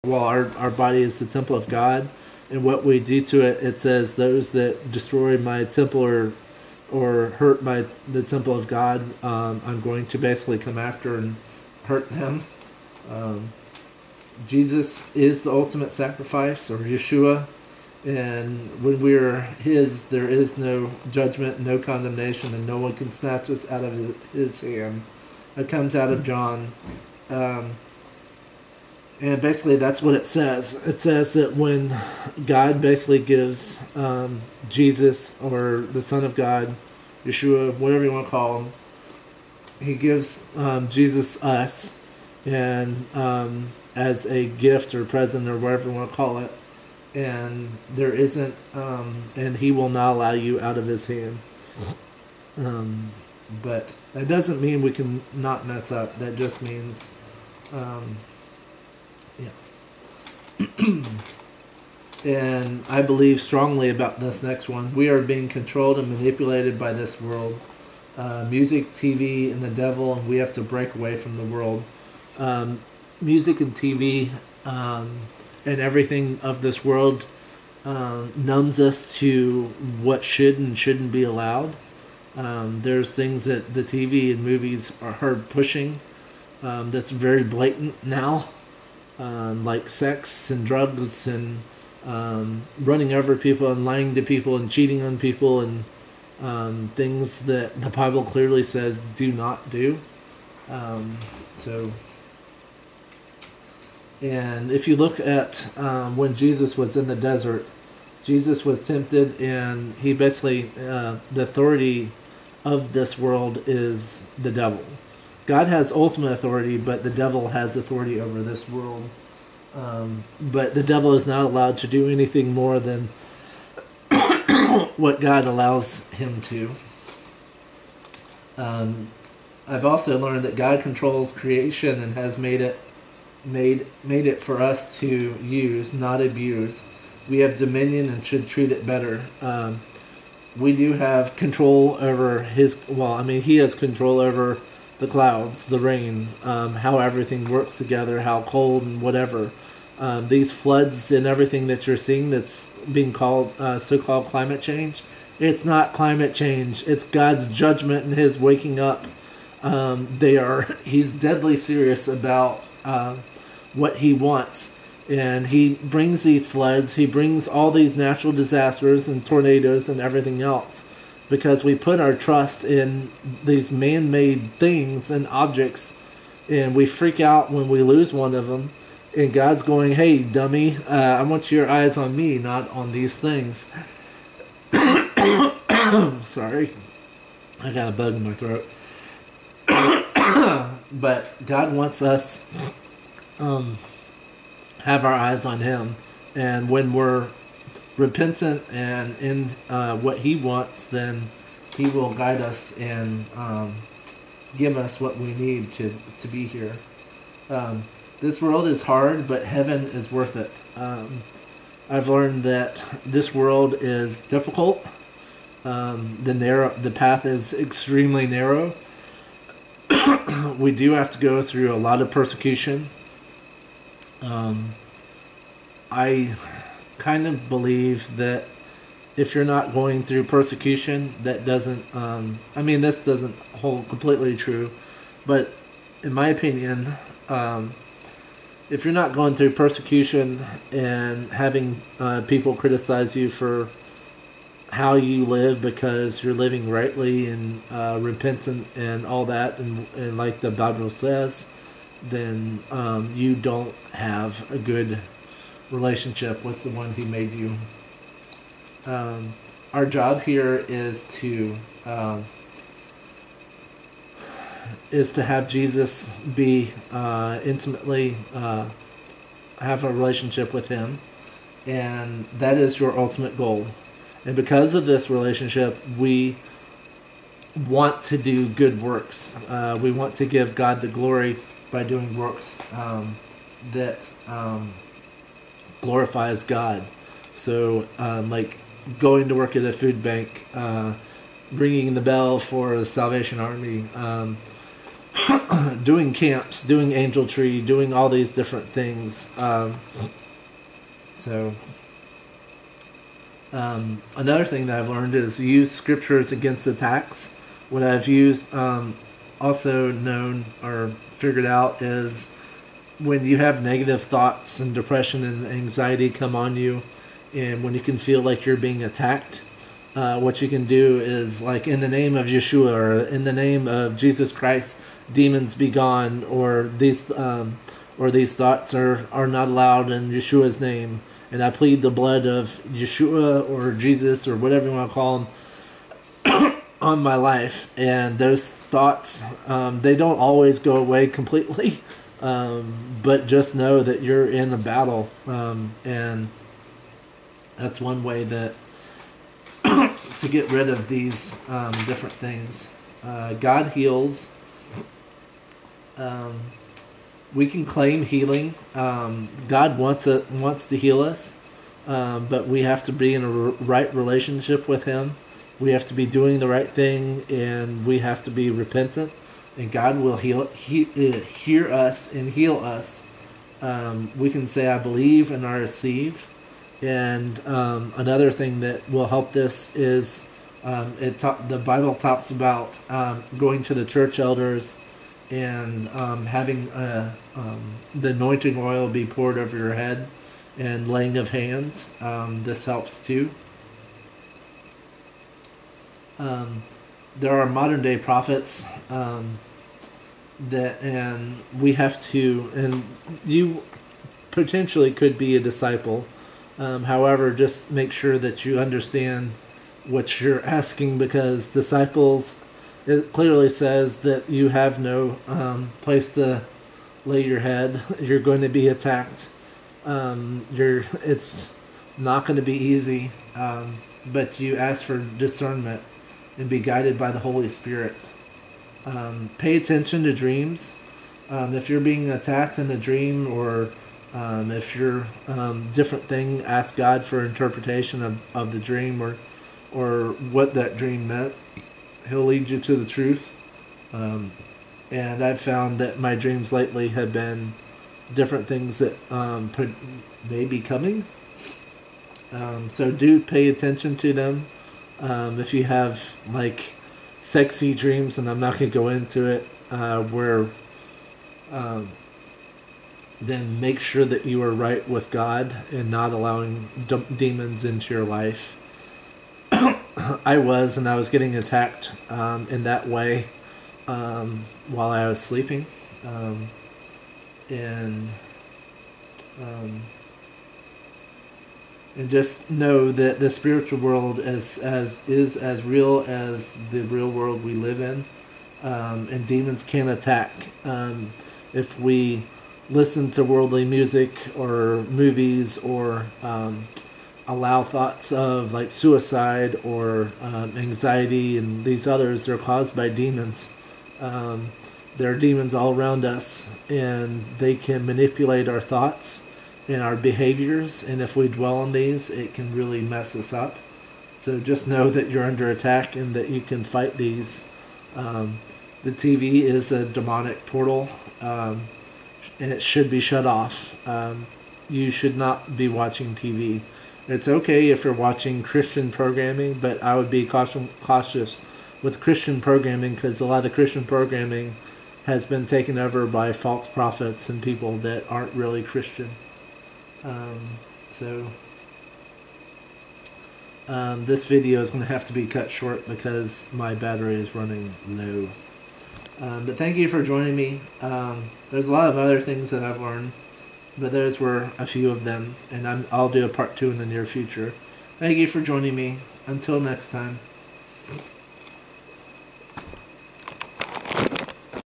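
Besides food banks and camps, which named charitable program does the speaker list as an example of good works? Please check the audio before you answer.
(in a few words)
Angel Tree.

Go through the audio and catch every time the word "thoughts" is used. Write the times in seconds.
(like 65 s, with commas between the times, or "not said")
314 s, 328 s, 338 s, 497 s, 508 s.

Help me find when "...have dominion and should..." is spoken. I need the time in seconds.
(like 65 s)
137 s.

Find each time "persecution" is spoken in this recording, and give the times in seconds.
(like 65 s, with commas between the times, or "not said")
222 s, 230 s, 239 s.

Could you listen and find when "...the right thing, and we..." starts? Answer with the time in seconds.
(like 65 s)
366 s.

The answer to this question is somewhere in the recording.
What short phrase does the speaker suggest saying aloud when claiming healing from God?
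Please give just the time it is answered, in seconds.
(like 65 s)
374 s.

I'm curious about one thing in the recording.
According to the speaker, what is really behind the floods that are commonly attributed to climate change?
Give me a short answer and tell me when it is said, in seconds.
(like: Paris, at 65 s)
God's judgment, at 157 s.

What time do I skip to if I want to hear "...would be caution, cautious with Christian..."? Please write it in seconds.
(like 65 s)
529 s.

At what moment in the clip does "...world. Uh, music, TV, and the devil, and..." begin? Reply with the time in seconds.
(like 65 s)
67 s.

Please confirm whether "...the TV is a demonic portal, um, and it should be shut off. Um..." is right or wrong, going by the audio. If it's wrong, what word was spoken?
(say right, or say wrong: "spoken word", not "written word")
right.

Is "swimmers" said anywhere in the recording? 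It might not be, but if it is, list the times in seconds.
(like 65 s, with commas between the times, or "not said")
not said.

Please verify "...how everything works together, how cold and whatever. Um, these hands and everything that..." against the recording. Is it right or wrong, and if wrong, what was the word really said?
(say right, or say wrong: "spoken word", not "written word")
wrong: "floods", not "hands".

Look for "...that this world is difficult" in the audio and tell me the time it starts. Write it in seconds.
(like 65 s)
212 s.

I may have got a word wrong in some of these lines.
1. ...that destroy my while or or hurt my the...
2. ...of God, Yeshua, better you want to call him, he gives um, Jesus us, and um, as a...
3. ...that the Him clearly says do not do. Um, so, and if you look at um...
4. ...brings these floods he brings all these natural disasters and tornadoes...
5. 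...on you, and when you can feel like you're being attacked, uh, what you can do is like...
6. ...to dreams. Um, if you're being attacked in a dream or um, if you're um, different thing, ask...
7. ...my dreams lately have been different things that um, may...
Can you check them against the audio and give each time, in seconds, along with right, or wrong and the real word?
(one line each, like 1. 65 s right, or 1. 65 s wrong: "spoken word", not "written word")
1. 4 s wrong: "temple", not "while"
2. 36 s wrong: "whatever", not "better"
3. 97 s wrong: "Bible", not "Him"
4. 165 s right
5. 316 s right
6. 430 s right
7. 445 s right.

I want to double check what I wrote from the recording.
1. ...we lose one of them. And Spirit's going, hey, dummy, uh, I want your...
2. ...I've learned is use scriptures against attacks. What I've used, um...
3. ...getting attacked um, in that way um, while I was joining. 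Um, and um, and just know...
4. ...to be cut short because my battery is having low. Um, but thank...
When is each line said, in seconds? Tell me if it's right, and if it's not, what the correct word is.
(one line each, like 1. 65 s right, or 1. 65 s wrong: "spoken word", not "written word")
1. 177 s wrong: "God", not "Spirit"
2. 304 s right
3. 471 s wrong: "sleeping", not "joining"
4. 545 s wrong: "running", not "having".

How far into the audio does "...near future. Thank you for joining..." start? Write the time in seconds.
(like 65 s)
556 s.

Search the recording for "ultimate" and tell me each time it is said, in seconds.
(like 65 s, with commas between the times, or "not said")
15 s, 115 s, 272 s.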